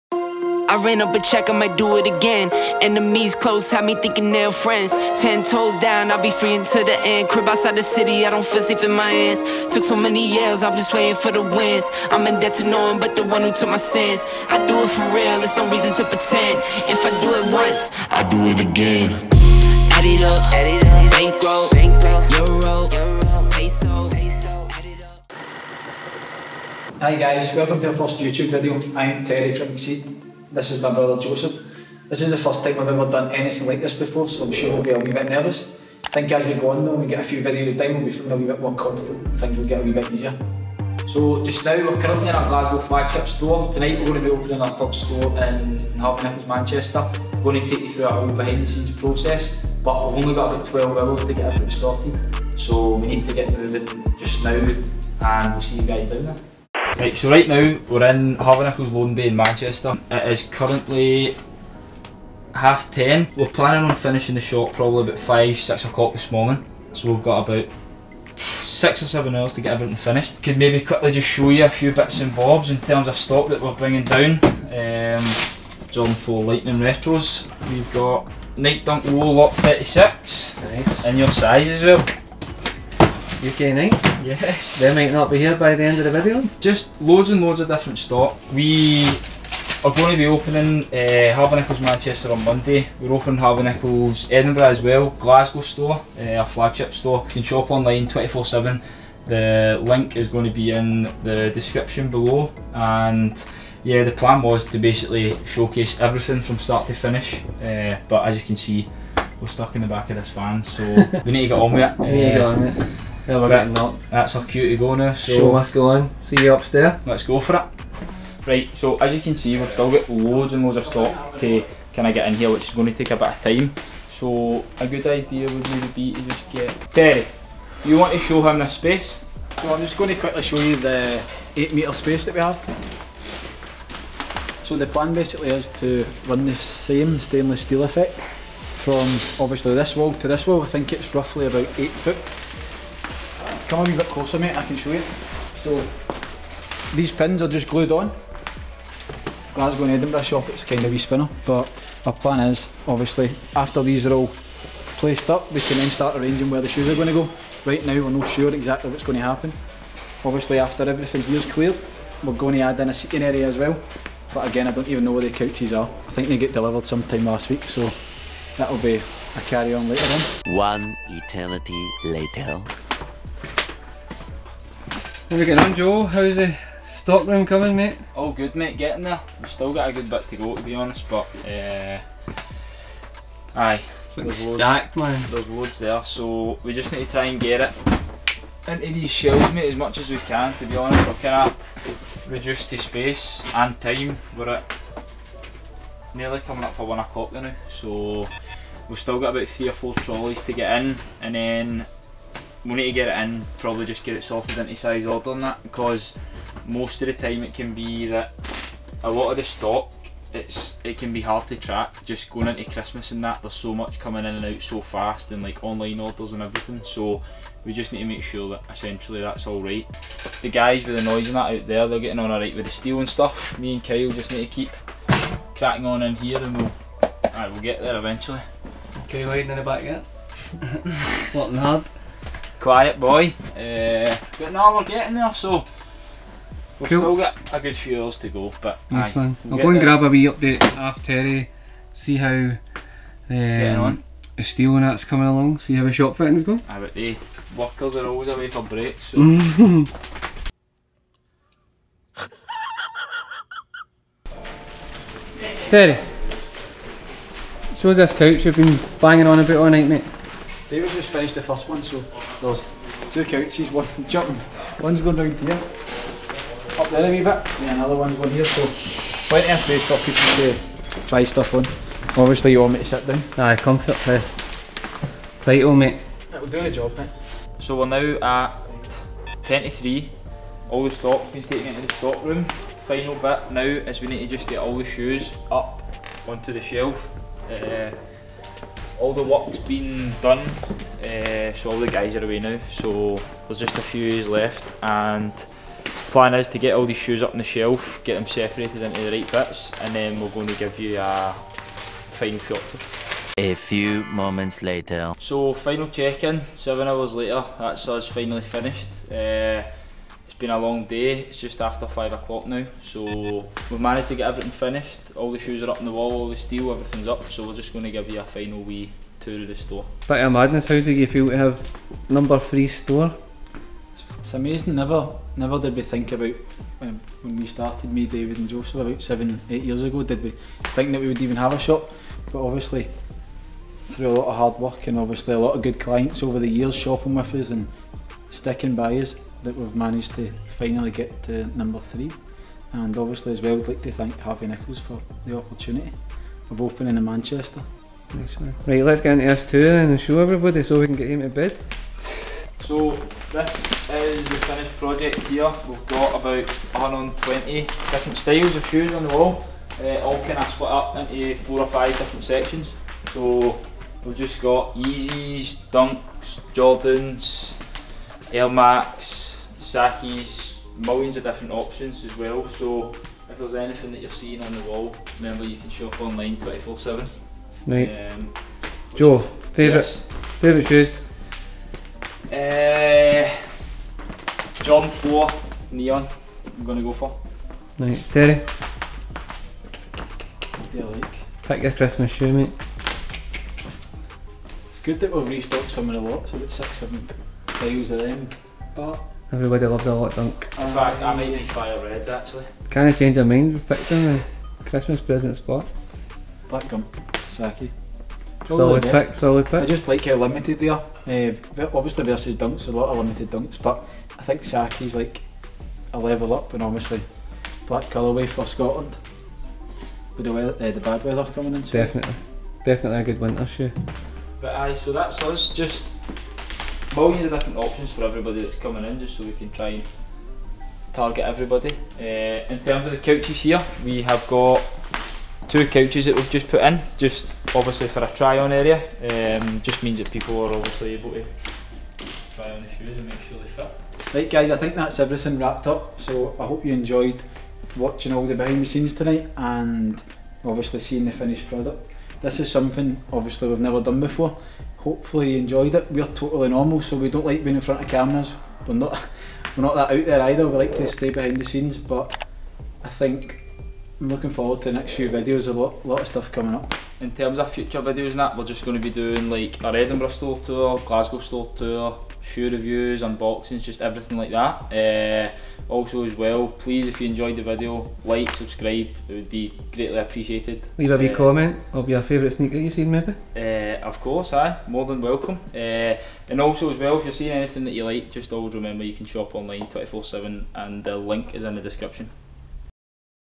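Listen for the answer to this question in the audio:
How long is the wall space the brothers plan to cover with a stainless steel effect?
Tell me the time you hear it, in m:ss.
2:11.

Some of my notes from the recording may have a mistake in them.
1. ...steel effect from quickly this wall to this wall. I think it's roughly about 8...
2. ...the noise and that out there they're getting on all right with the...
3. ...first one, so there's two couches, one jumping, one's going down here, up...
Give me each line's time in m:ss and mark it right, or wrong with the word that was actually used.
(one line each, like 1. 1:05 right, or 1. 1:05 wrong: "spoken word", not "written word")
1. 2:17 wrong: "obviously", not "quickly"
2. 3:40 right
3. 4:21 right.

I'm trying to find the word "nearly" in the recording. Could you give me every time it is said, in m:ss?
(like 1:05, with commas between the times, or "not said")
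3:16.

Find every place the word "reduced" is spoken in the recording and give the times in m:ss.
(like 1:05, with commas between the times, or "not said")
3:12.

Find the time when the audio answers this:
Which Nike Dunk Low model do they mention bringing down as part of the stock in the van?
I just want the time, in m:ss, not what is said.
1:19.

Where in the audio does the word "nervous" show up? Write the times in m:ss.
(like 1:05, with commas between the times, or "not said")
0:35.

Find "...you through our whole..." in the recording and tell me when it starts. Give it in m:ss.
0:47.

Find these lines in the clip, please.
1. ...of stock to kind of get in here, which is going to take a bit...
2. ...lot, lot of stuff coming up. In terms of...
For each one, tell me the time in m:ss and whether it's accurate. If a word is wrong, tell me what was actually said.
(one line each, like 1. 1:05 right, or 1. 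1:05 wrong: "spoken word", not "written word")
1. 2:00 right
2. 7:45 right.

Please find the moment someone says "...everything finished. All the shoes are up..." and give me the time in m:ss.
5:14.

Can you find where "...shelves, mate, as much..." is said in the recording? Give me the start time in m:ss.
3:09.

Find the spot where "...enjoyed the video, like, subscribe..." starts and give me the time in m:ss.
7:57.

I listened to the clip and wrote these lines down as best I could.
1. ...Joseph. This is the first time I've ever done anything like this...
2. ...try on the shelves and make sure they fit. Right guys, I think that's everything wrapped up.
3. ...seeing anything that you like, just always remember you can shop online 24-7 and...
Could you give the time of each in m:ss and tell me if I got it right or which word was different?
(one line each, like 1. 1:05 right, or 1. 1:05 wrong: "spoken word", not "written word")
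1. 0:31 right
2. 7:22 wrong: "shoes", not "shelves"
3. 8:07 right.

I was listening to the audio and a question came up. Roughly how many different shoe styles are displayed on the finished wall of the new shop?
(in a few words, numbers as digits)
120.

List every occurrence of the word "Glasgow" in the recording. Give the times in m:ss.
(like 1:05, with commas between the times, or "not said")
0:42, 1:35, 2:29, 7:50.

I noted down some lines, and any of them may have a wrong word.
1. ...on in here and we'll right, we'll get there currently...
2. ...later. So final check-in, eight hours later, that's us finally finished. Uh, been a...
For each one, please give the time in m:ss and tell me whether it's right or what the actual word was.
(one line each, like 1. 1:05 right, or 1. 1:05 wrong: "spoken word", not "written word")
1. 3:45 wrong: "eventually", not "currently"
2. 5:04 wrong: "seven", not "eight".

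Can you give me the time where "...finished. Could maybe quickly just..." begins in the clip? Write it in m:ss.
1:09.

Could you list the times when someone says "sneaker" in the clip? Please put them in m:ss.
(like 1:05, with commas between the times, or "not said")
8:02.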